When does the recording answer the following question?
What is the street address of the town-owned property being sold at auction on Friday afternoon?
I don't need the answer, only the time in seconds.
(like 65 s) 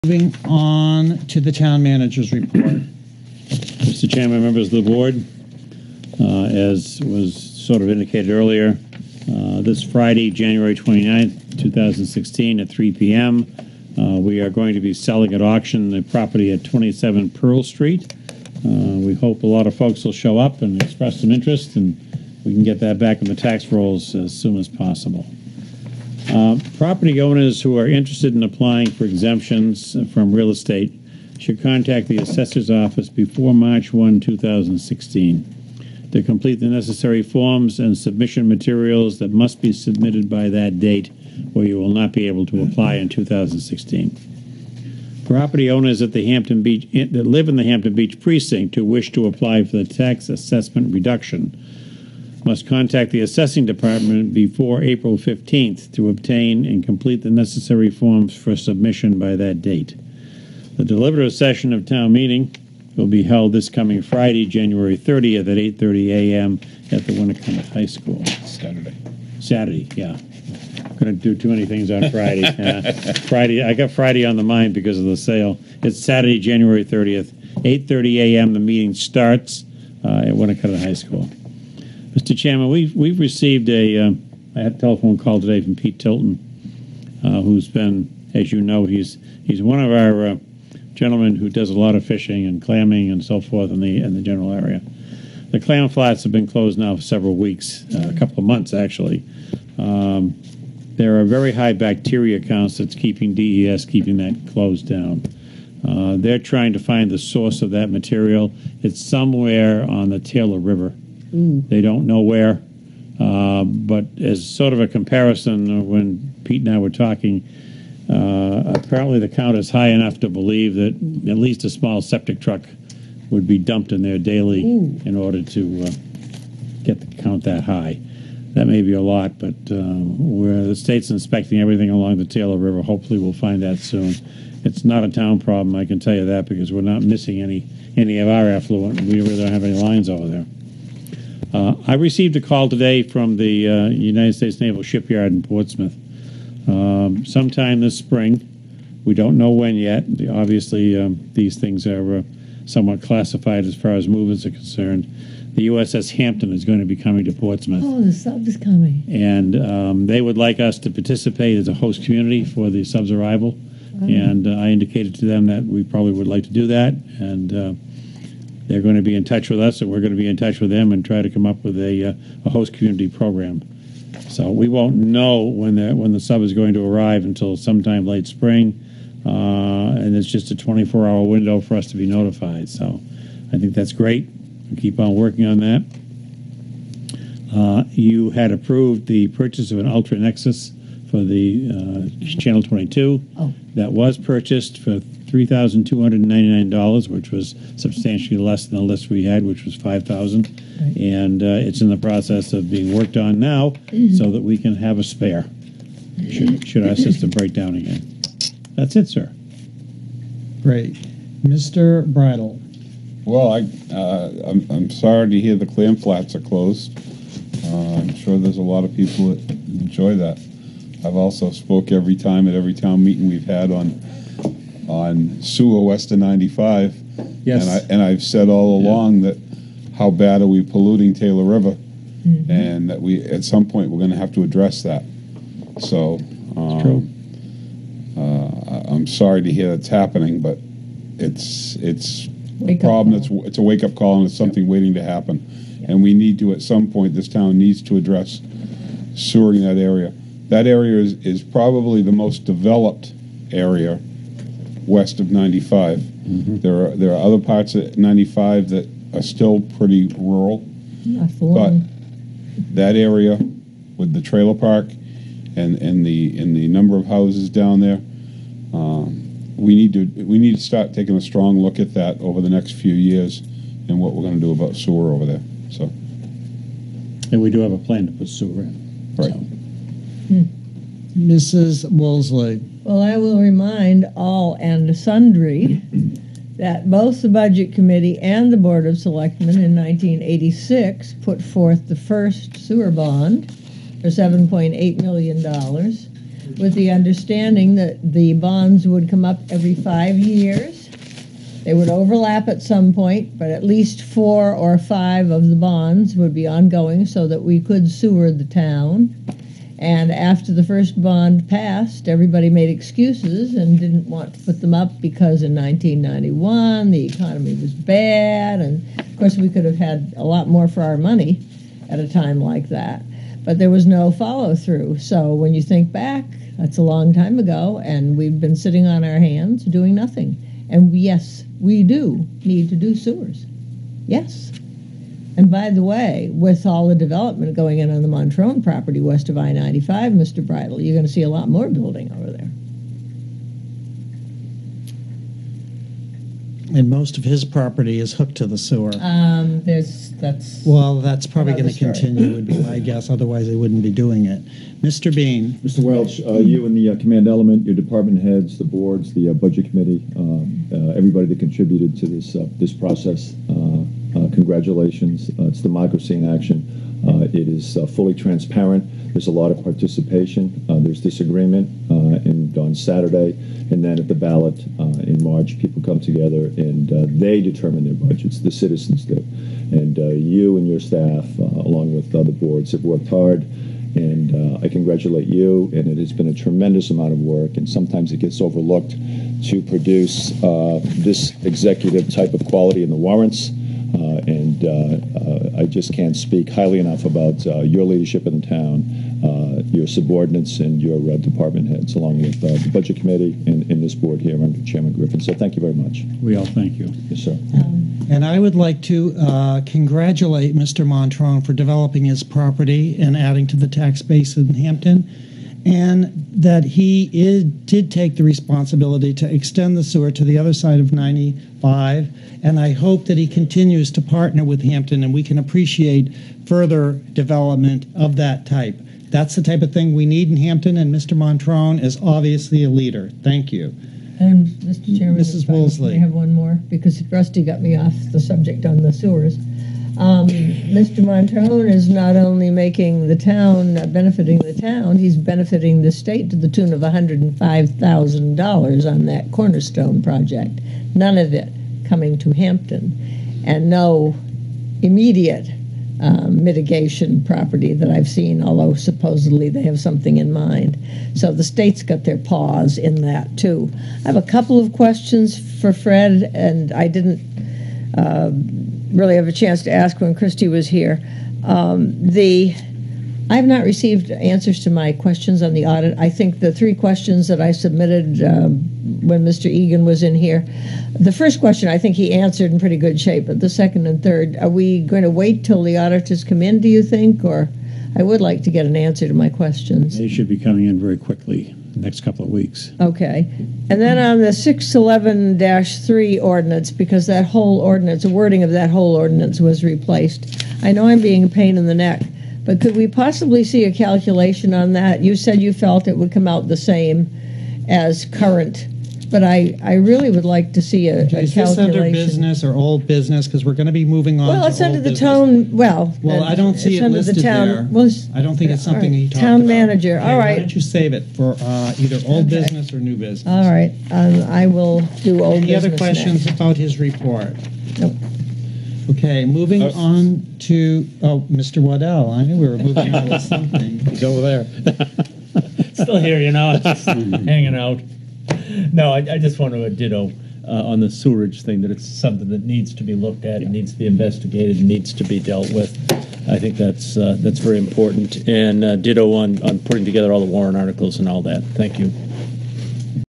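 16 s.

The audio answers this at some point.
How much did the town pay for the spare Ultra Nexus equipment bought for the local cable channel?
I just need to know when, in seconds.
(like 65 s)
195 s.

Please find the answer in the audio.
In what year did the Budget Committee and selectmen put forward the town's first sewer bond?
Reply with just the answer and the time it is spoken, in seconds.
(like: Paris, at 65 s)
1986, at 289 s.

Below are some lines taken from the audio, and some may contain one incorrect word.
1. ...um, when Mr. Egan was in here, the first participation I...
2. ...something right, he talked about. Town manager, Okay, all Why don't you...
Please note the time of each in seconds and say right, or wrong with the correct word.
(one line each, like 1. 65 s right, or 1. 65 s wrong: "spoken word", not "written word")
1. 478 s wrong: "question", not "participation"
2. 518 s right.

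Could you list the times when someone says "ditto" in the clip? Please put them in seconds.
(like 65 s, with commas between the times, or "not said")
539 s, 548 s.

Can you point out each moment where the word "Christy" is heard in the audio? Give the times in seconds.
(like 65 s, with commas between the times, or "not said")
470 s.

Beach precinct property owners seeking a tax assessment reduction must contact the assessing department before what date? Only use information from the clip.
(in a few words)
April 15th.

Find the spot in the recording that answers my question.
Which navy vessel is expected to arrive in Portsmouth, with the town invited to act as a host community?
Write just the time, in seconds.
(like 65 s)
155 s.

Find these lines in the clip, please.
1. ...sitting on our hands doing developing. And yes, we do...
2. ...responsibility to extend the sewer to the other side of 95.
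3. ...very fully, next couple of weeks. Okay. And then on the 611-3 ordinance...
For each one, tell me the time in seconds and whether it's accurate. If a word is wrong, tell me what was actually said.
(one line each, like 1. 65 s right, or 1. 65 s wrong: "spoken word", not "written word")
1. 328 s wrong: "nothing", not "developing"
2. 418 s right
3. 490 s wrong: "quickly", not "fully".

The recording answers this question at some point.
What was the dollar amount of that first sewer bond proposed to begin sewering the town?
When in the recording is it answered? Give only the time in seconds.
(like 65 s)
294 s.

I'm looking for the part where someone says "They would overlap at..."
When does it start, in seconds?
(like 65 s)
301 s.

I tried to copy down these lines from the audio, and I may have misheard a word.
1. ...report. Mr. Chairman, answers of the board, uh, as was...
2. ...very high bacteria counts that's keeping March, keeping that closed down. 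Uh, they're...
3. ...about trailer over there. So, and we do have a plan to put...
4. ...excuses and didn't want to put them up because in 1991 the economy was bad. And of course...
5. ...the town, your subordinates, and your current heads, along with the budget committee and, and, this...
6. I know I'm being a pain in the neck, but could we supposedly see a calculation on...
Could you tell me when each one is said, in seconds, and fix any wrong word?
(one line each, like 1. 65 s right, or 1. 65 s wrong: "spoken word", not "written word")
1. 2 s wrong: "members", not "answers"
2. 101 s wrong: "DES", not "March"
3. 274 s wrong: "sewer", not "trailer"
4. 312 s right
5. 398 s wrong: "department", not "current"
6. 500 s wrong: "possibly", not "supposedly".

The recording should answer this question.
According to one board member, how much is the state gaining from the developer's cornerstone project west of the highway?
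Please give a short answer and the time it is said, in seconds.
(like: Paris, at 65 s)
$105,000, at 446 s.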